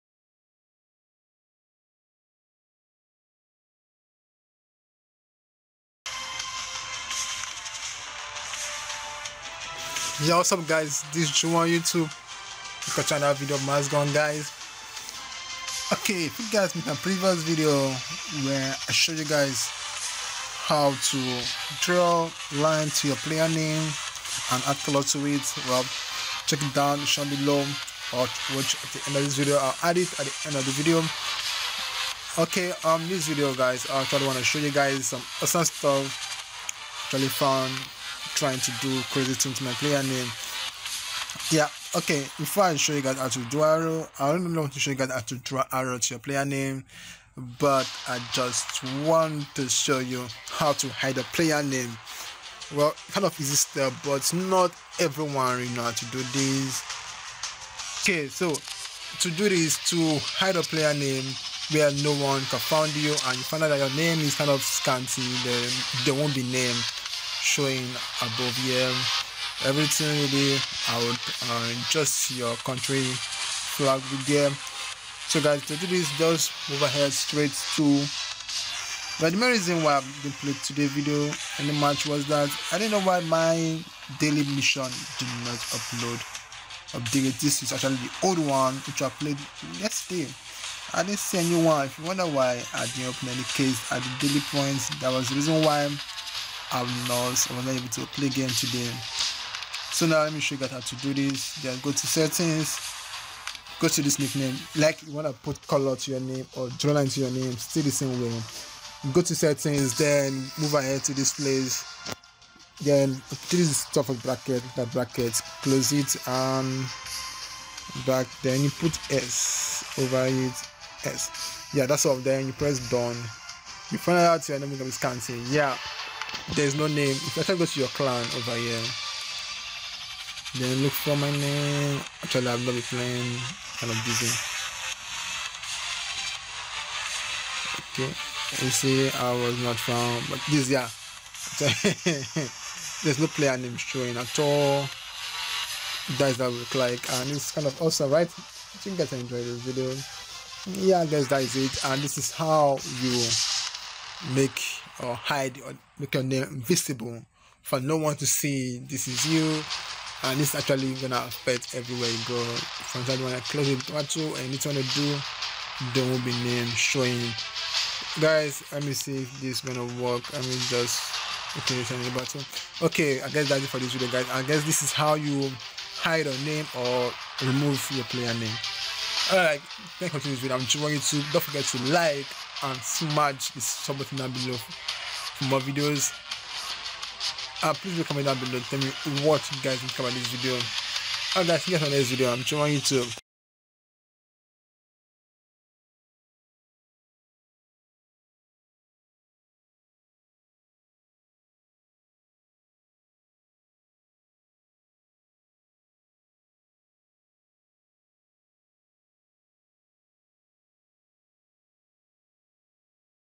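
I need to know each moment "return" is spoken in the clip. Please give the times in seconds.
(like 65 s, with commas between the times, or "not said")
171 s.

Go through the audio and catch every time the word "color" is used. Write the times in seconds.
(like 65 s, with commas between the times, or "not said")
24 s, 105 s.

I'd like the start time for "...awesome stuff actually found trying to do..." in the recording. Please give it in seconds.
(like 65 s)
35 s.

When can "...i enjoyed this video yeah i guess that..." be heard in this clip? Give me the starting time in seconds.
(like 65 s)
149 s.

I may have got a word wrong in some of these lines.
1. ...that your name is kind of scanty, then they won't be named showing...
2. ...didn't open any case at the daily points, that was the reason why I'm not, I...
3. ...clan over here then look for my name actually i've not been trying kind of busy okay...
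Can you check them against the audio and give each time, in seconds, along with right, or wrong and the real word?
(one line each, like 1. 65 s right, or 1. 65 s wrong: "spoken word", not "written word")
1. 63 s right
2. 92 s right
3. 127 s wrong: "playing", not "trying".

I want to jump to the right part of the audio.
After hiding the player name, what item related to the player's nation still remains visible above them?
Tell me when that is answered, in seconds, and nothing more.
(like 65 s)
72 s.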